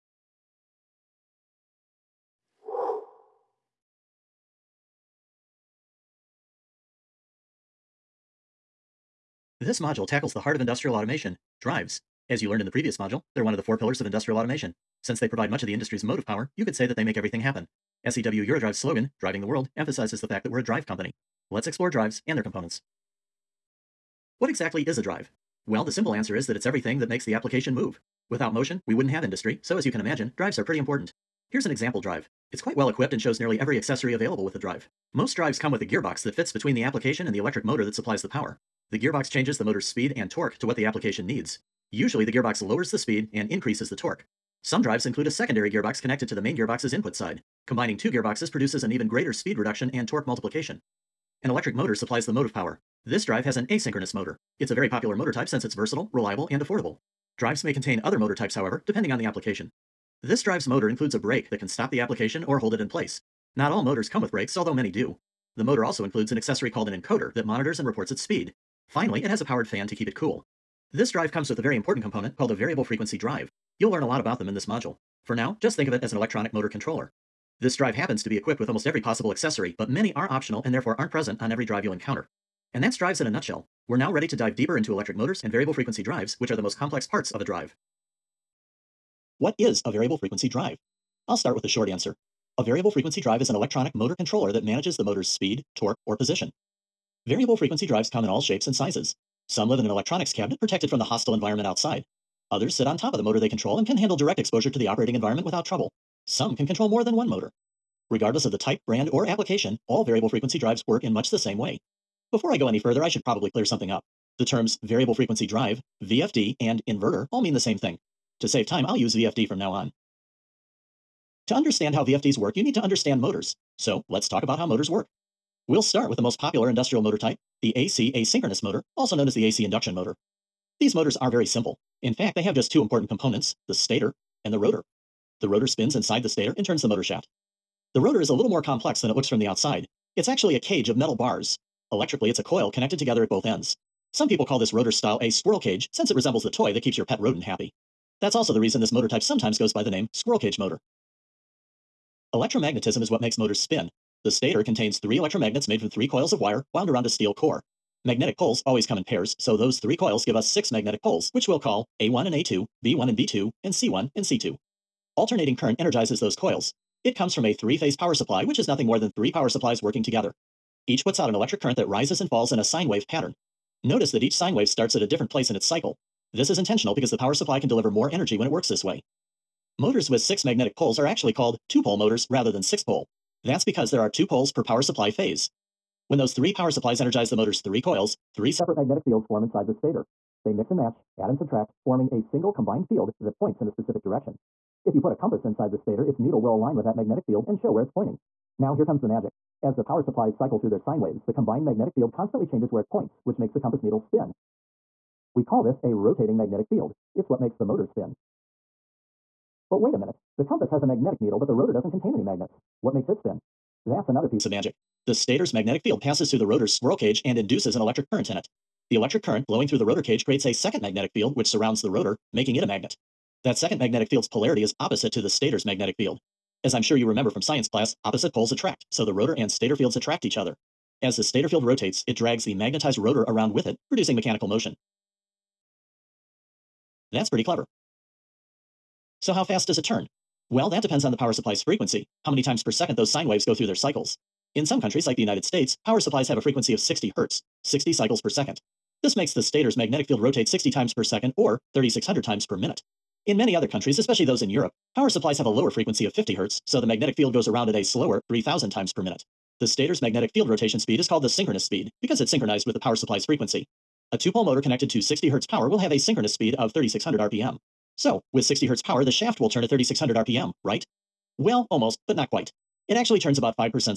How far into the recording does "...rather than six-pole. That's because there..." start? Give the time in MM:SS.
03:02.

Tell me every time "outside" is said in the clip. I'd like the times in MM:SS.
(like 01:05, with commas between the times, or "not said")
01:41, 02:19.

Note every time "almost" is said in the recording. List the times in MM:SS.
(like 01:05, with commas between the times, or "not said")
01:18, 04:31.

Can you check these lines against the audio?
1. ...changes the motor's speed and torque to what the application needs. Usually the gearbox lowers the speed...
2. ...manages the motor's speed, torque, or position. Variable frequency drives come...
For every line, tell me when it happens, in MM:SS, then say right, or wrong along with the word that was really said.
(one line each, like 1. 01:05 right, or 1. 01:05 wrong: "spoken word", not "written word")
1. 00:39 right
2. 01:34 right.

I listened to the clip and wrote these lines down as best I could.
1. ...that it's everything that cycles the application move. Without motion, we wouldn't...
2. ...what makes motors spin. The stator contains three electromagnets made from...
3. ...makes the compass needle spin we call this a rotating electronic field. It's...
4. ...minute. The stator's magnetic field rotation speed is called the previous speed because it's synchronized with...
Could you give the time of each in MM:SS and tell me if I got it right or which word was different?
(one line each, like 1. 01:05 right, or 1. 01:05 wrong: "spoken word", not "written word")
1. 00:26 wrong: "makes", not "cycles"
2. 02:33 right
3. 03:23 wrong: "magnetic", not "electronic"
4. 04:19 wrong: "synchronous", not "previous".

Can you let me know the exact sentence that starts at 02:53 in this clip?
Notice that each sine wave starts at a different place in its cycle.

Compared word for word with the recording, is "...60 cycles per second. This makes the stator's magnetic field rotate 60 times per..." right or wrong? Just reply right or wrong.
right.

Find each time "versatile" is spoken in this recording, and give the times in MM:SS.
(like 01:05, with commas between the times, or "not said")
00:55.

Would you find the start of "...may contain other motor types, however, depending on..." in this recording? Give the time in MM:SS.
00:57.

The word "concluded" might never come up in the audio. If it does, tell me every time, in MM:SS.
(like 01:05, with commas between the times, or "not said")
not said.